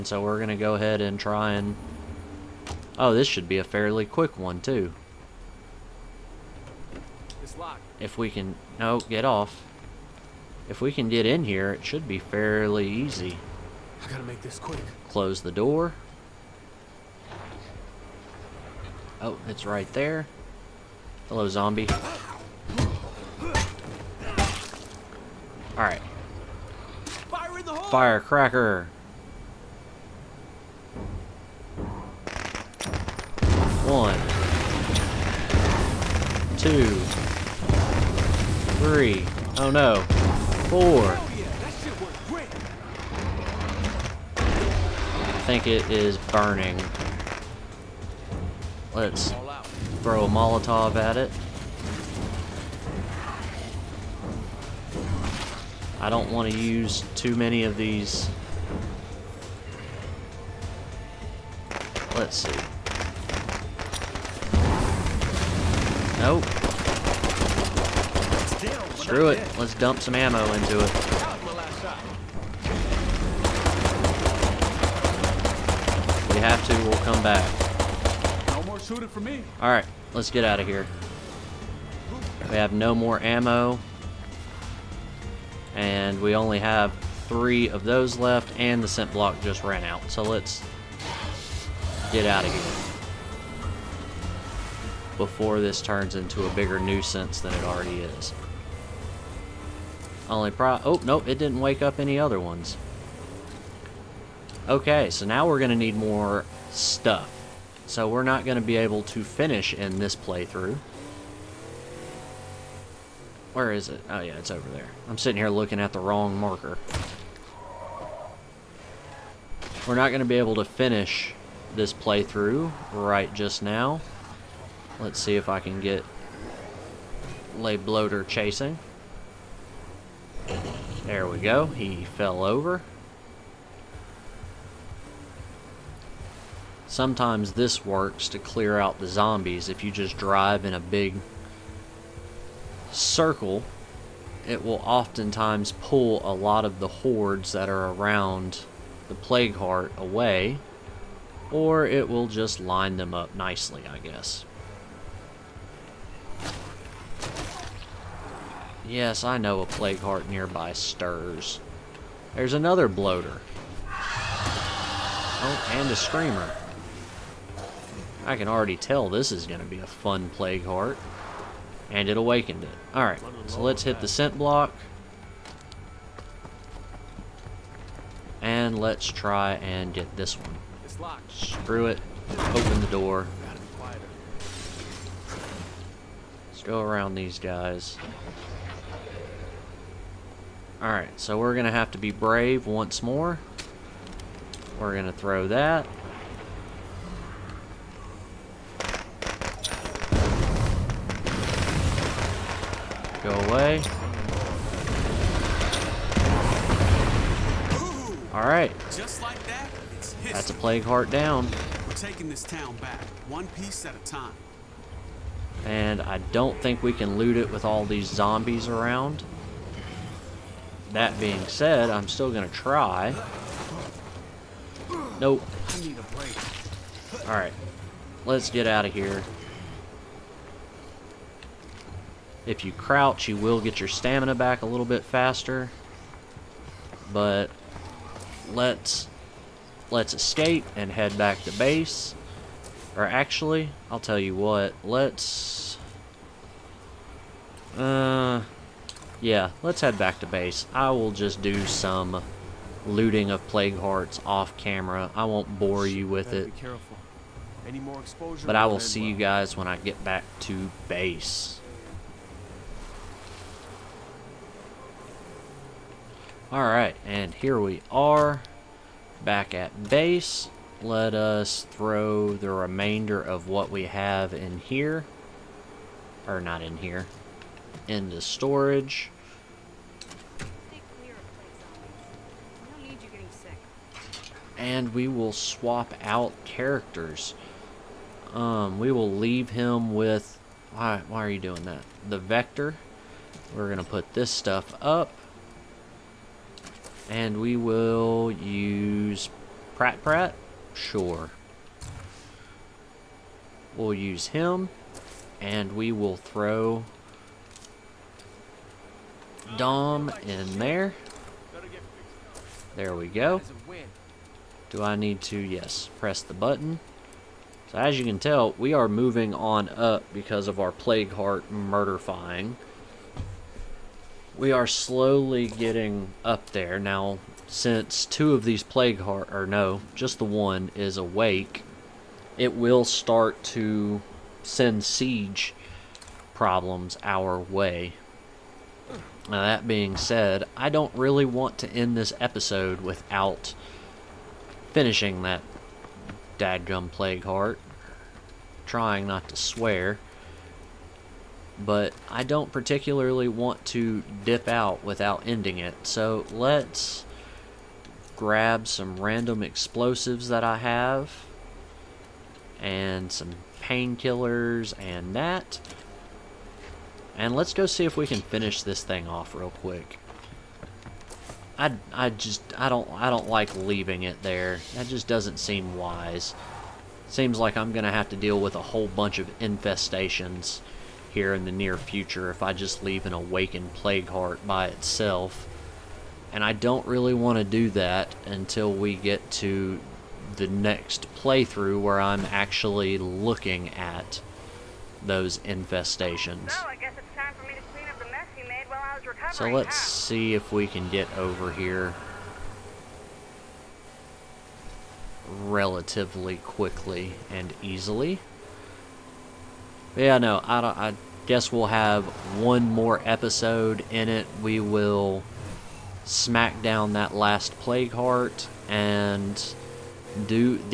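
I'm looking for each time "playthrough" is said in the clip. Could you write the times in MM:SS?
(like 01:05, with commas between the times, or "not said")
01:50, 02:01, 06:31.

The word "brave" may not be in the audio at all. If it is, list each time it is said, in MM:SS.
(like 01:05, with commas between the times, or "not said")
03:12.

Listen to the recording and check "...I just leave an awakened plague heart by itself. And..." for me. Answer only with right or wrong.
right.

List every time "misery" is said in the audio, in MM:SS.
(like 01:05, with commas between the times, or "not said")
not said.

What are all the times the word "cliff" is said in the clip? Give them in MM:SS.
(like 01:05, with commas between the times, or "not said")
not said.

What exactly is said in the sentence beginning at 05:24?
We are slowly getting up there.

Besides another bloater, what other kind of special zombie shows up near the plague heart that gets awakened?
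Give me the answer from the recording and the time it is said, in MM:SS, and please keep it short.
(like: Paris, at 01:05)
screamer, at 02:45.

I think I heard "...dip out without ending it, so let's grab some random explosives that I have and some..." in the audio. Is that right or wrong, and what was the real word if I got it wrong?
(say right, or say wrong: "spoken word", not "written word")
right.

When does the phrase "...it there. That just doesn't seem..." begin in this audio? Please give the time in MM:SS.
06:14.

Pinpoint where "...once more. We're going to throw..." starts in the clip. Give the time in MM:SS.
03:12.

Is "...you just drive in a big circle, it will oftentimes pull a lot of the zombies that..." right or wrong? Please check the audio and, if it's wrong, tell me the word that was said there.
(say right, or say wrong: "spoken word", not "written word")
wrong: "hordes", not "zombies".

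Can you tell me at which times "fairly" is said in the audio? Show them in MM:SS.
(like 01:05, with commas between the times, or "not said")
00:03, 00:12.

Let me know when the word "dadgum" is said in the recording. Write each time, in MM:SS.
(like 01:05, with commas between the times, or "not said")
05:46.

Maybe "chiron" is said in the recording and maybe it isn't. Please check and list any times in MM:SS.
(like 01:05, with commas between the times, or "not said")
not said.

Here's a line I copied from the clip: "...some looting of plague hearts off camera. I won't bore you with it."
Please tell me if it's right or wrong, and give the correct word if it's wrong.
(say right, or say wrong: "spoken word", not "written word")
right.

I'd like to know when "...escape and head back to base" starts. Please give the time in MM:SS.
04:00.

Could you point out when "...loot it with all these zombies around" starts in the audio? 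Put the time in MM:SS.
03:37.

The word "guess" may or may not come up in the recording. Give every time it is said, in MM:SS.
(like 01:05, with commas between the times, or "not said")
02:33, 06:51.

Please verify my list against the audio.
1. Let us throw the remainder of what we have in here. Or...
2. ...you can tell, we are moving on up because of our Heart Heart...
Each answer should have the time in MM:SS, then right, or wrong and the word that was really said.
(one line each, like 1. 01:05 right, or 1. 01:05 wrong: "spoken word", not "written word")
1. 04:30 right
2. 05:17 wrong: "Plague", not "Heart".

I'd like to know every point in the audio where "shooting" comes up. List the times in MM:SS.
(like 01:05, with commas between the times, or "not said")
01:18.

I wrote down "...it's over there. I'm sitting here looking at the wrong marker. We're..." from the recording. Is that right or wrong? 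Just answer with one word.
right.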